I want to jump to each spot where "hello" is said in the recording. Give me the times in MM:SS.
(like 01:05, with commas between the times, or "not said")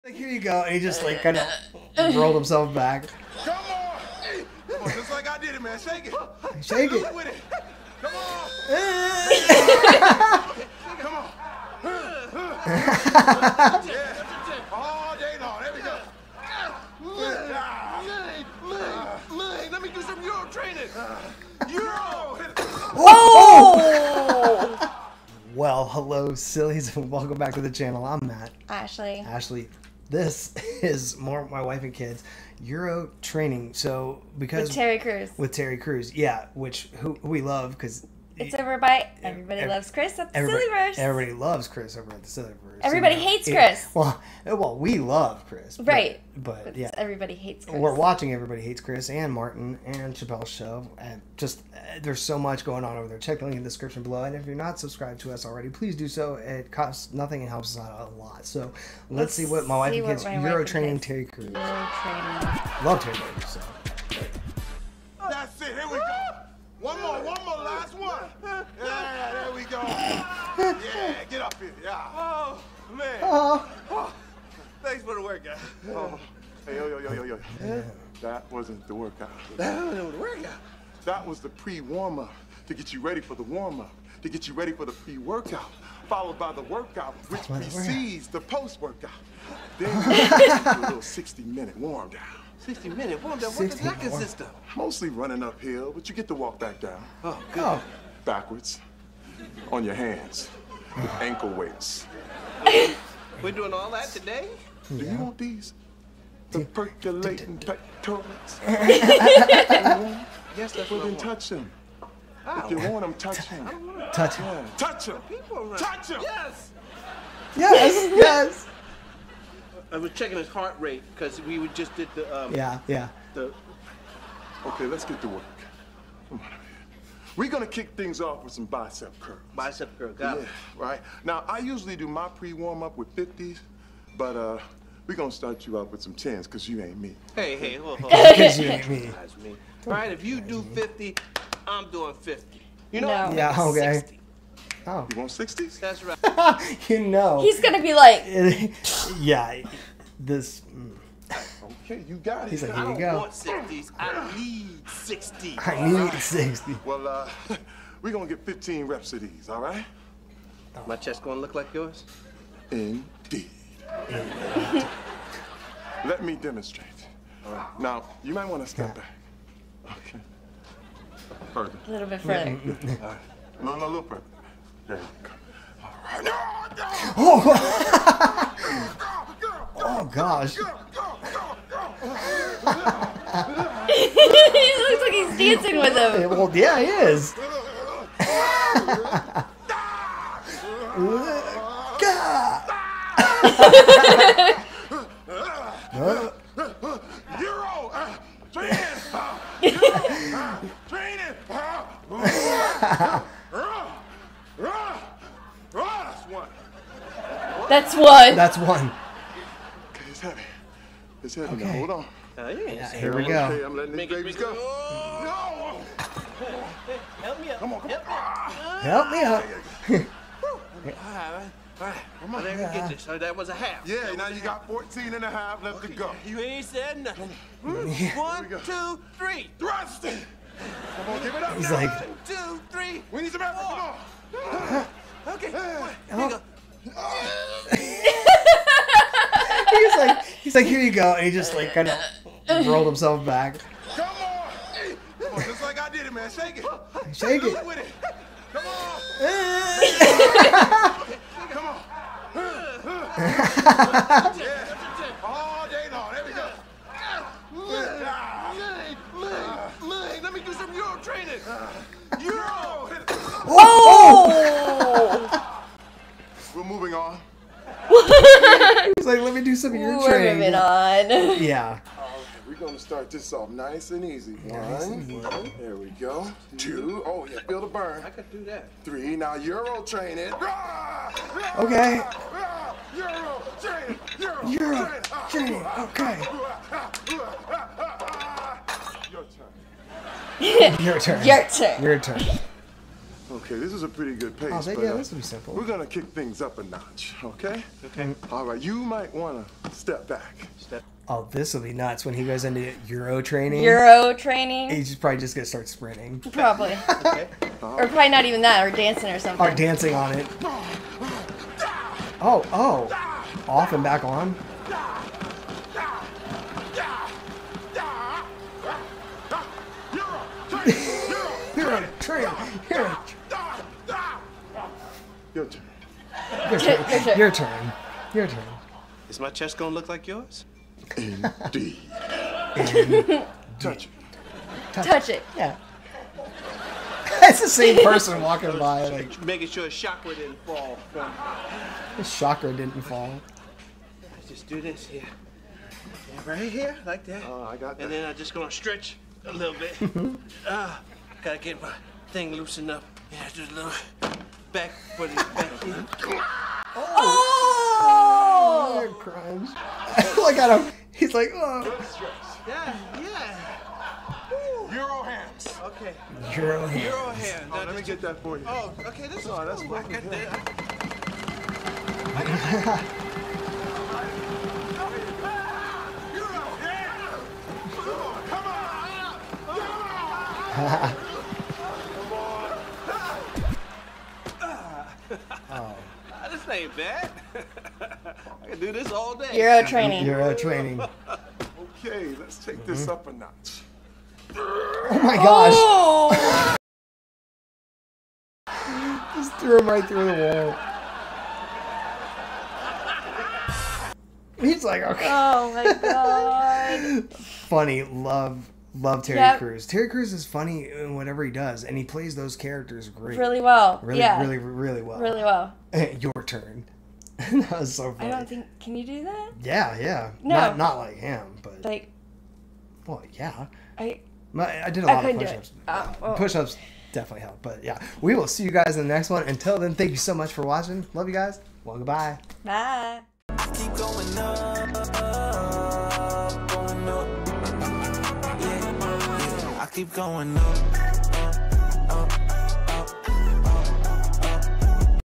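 00:25.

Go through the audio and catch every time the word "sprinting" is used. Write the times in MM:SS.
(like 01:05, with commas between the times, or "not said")
05:05.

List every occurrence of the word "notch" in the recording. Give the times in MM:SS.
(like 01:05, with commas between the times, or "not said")
04:56, 06:33.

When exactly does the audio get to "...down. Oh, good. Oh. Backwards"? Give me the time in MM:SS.
01:36.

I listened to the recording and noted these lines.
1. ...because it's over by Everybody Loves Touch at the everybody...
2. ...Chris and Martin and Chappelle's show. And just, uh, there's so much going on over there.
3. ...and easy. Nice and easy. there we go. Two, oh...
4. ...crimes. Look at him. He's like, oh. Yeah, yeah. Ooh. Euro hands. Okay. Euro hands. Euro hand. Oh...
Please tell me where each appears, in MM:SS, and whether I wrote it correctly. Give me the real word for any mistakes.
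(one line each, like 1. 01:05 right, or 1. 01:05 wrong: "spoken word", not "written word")
1. 00:37 wrong: "Chris", not "Touch"
2. 00:48 right
3. 04:33 right
4. 05:58 right.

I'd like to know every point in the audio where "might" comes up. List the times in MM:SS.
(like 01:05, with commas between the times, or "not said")
02:48, 04:58.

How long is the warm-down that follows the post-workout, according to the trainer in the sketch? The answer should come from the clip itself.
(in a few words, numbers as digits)
60 minutes.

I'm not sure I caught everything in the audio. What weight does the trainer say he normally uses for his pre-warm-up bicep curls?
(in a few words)
50.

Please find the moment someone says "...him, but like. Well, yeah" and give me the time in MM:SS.
07:00.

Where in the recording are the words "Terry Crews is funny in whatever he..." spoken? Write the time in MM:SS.
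06:49.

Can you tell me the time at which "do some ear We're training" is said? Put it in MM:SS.
04:29.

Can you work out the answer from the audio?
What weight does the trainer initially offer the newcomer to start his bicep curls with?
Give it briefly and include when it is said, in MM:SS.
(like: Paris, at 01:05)
10, at 02:16.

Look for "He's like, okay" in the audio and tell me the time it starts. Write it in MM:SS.
06:44.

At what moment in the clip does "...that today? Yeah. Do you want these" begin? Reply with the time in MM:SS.
01:43.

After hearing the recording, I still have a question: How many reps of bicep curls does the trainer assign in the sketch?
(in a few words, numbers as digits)
15.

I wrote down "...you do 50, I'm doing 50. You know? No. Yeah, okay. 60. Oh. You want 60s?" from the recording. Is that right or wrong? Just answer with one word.
right.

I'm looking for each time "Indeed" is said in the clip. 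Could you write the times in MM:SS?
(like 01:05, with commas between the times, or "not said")
02:42, 05:30.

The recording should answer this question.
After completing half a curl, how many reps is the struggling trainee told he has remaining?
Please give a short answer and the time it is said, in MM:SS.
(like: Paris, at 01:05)
14 and a half, at 03:44.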